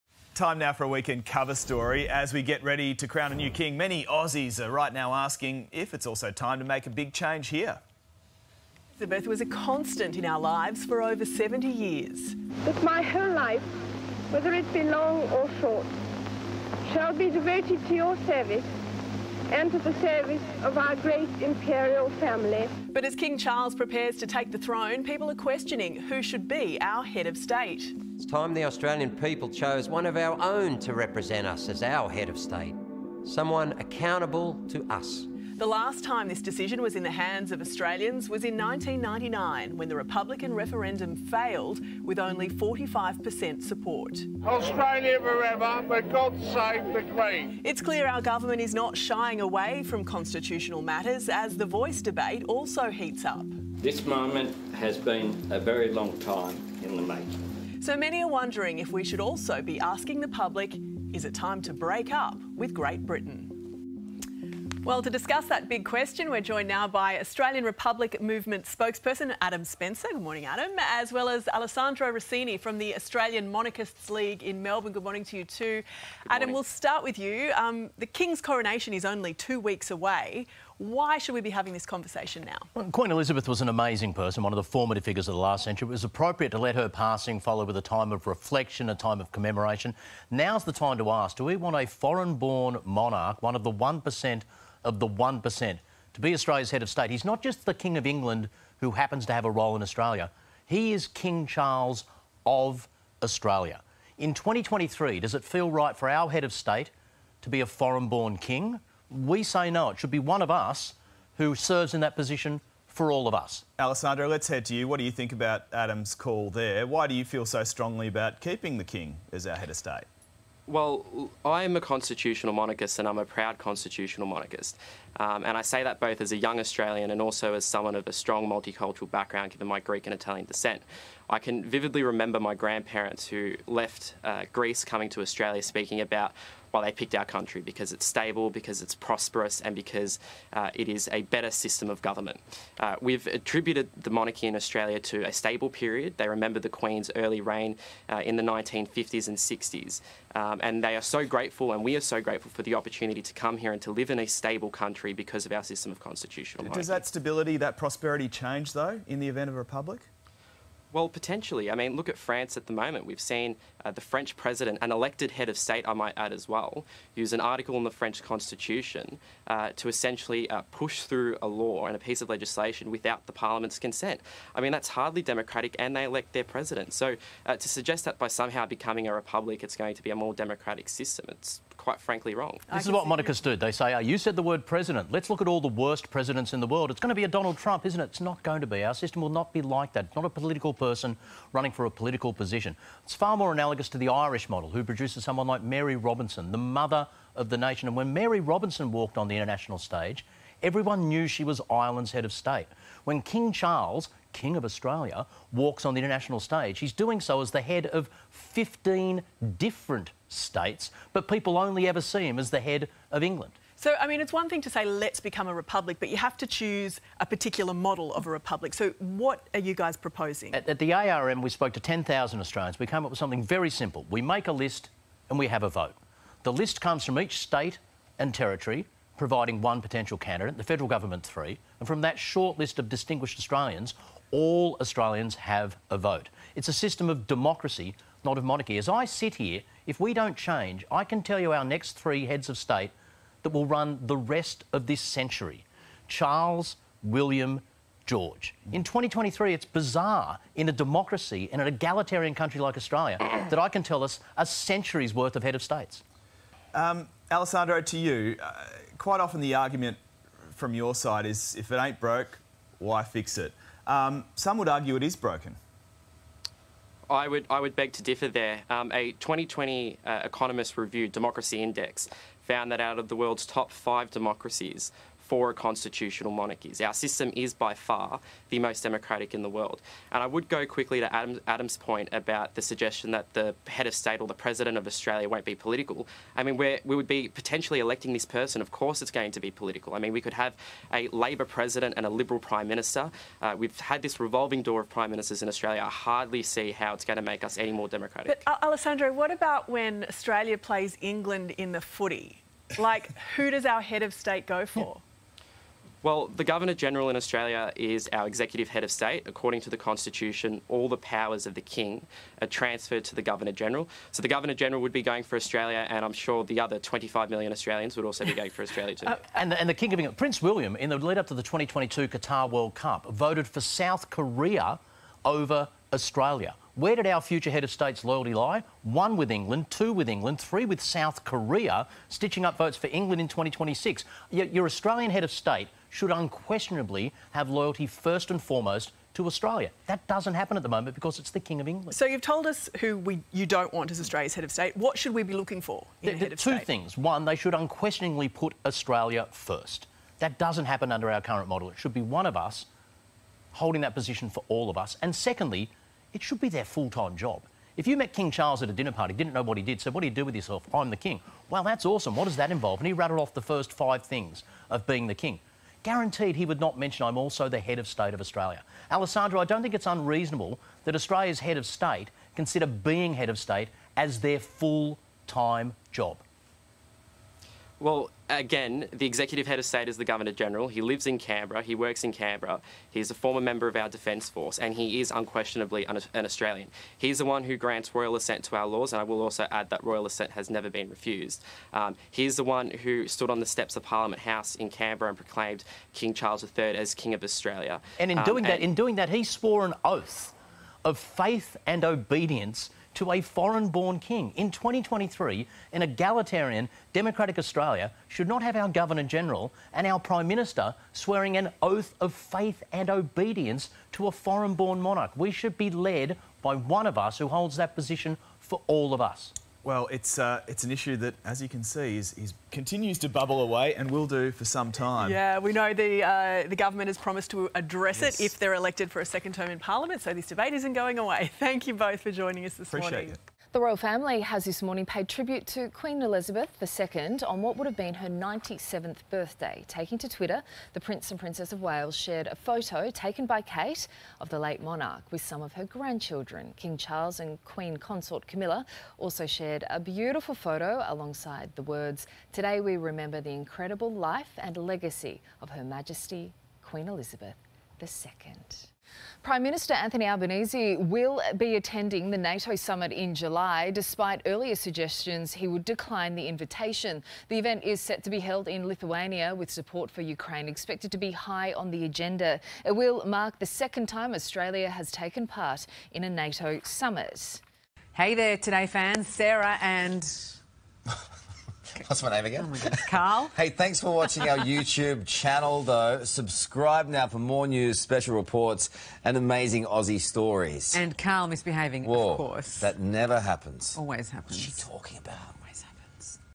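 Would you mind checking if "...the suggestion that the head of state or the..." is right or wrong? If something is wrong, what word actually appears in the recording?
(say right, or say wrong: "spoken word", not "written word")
right.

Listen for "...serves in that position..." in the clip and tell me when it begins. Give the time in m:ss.
1:51.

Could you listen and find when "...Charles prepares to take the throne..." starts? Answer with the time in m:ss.
0:23.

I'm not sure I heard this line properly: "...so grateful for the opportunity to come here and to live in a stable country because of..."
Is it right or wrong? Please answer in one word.
right.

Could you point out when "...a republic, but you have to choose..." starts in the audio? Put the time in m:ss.
3:35.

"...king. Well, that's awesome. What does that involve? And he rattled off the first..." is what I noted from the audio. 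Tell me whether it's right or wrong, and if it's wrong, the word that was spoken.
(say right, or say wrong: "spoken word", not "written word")
right.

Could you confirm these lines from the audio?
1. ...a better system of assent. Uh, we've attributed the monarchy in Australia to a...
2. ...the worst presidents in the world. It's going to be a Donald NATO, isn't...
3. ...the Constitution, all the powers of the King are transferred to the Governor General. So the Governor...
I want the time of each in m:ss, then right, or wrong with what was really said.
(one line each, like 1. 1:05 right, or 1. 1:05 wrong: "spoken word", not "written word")
1. 2:21 wrong: "government", not "assent"
2. 3:05 wrong: "Trump", not "NATO"
3. 5:09 right.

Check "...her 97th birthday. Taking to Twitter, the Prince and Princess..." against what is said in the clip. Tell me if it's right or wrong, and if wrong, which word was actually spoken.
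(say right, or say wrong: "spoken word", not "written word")
right.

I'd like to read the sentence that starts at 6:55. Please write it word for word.
We should be led by one of us who holds that position for all of us.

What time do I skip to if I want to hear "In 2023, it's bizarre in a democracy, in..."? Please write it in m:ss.
4:08.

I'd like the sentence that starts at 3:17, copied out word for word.
And when Mary Robinson walked on the international stage, everyone knew she was Ireland's head of state.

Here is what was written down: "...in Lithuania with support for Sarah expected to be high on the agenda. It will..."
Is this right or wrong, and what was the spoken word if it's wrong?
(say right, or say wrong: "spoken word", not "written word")
wrong: "Ukraine", not "Sarah".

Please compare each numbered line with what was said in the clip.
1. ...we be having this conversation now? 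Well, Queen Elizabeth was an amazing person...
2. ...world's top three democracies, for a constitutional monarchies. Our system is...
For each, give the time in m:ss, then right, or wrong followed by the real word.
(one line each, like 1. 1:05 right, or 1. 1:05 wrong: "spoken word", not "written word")
1. 1:21 right
2. 4:33 wrong: "five", not "three".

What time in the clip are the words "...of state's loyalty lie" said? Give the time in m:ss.
5:27.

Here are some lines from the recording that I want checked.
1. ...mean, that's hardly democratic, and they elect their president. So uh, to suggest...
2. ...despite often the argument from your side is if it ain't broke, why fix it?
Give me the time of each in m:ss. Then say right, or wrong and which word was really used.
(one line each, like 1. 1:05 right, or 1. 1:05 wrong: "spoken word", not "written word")
1. 2:54 right
2. 4:18 wrong: "quite", not "despite".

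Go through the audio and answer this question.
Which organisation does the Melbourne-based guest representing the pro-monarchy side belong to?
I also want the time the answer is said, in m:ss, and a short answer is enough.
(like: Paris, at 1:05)
Australian Monarchists League, at 1:12.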